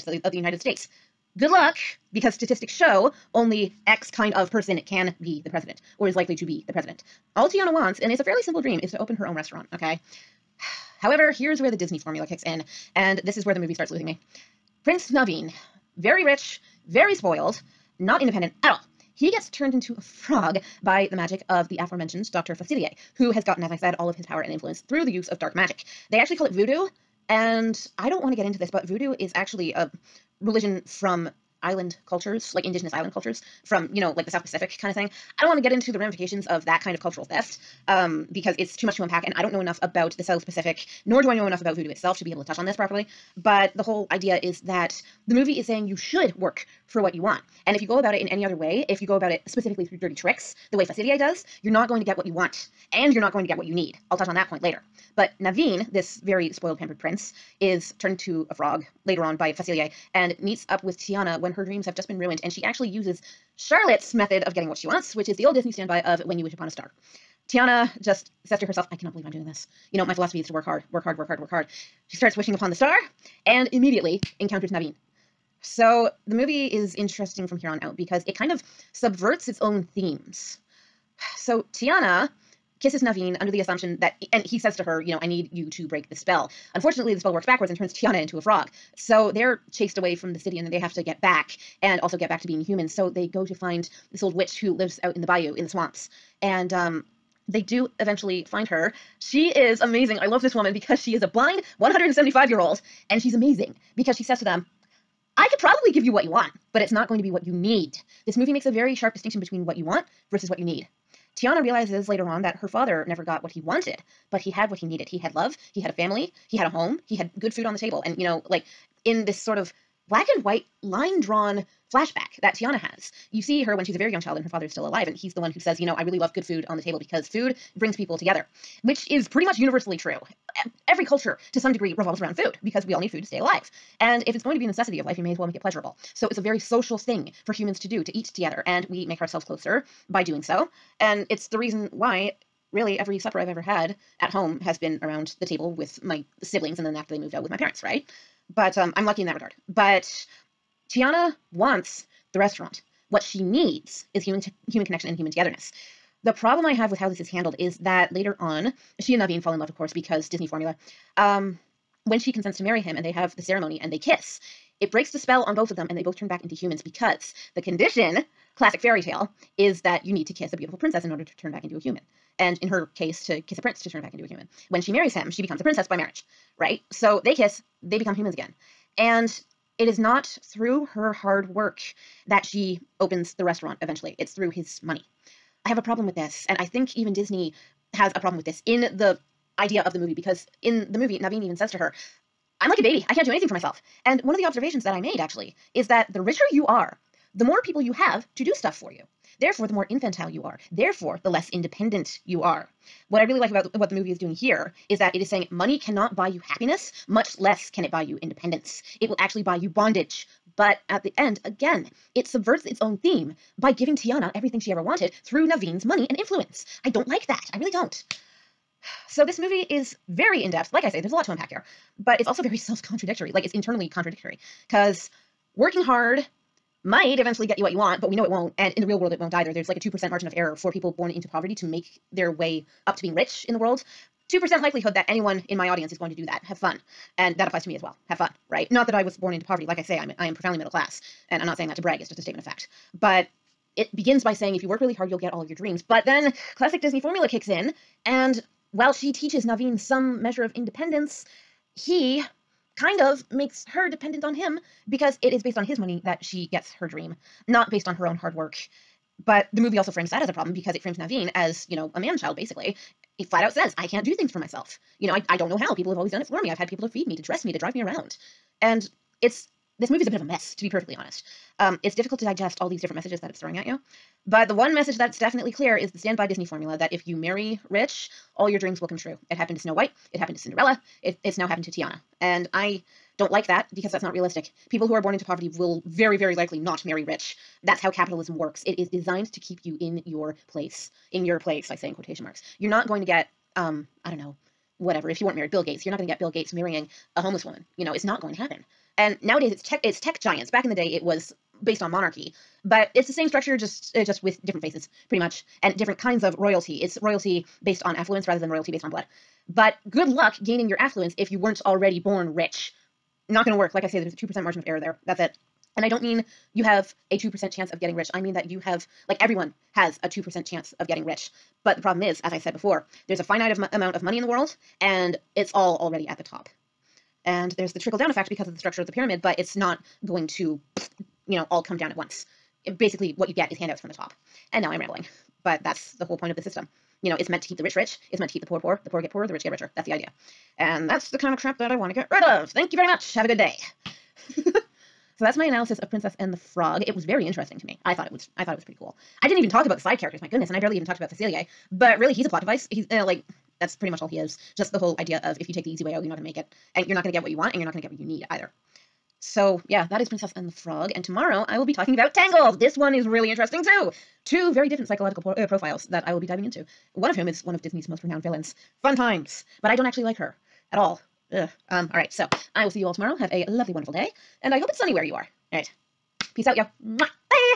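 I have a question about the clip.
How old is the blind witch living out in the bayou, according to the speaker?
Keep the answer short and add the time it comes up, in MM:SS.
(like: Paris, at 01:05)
175, at 01:41.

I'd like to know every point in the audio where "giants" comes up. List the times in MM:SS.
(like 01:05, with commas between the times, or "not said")
05:00.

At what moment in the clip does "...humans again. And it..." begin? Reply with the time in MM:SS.
02:58.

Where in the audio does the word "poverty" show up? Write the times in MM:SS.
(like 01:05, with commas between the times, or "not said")
03:51, 03:59, 04:45.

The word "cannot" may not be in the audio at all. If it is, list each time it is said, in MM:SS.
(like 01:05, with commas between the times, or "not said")
01:08, 03:25.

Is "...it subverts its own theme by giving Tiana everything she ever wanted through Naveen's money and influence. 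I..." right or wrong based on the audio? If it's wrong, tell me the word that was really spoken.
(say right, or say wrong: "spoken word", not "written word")
right.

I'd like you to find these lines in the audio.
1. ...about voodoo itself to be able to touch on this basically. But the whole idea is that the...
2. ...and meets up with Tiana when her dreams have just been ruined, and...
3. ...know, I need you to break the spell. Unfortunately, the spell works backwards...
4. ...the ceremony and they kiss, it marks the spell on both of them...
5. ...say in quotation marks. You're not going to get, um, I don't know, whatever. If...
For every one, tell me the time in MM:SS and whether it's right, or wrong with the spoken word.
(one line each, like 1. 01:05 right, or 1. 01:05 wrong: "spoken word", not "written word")
1. 00:41 wrong: "properly", not "basically"
2. 01:00 right
3. 01:25 right
4. 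02:43 wrong: "breaks", not "marks"
5. 04:51 right.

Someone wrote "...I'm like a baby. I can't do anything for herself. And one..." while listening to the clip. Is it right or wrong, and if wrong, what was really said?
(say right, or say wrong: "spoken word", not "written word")
wrong: "myself", not "herself".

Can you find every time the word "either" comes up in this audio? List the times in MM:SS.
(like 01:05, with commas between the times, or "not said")
03:49, 05:58.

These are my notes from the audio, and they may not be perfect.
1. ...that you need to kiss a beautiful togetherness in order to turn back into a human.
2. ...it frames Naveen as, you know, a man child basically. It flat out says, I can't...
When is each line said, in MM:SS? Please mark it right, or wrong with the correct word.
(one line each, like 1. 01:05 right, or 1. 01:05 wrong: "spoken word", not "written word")
1. 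02:49 wrong: "princess", not "togetherness"
2. 04:20 right.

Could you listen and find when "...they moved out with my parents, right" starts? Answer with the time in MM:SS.
02:27.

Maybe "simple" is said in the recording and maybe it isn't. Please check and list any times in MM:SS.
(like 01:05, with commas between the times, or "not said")
00:08.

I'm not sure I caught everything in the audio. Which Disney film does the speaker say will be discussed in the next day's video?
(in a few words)
Tangled.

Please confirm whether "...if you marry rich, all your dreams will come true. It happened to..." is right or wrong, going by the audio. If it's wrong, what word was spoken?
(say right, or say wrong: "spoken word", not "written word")
right.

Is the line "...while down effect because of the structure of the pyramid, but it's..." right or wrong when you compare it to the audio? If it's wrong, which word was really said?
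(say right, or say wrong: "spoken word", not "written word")
wrong: "trickle", not "while".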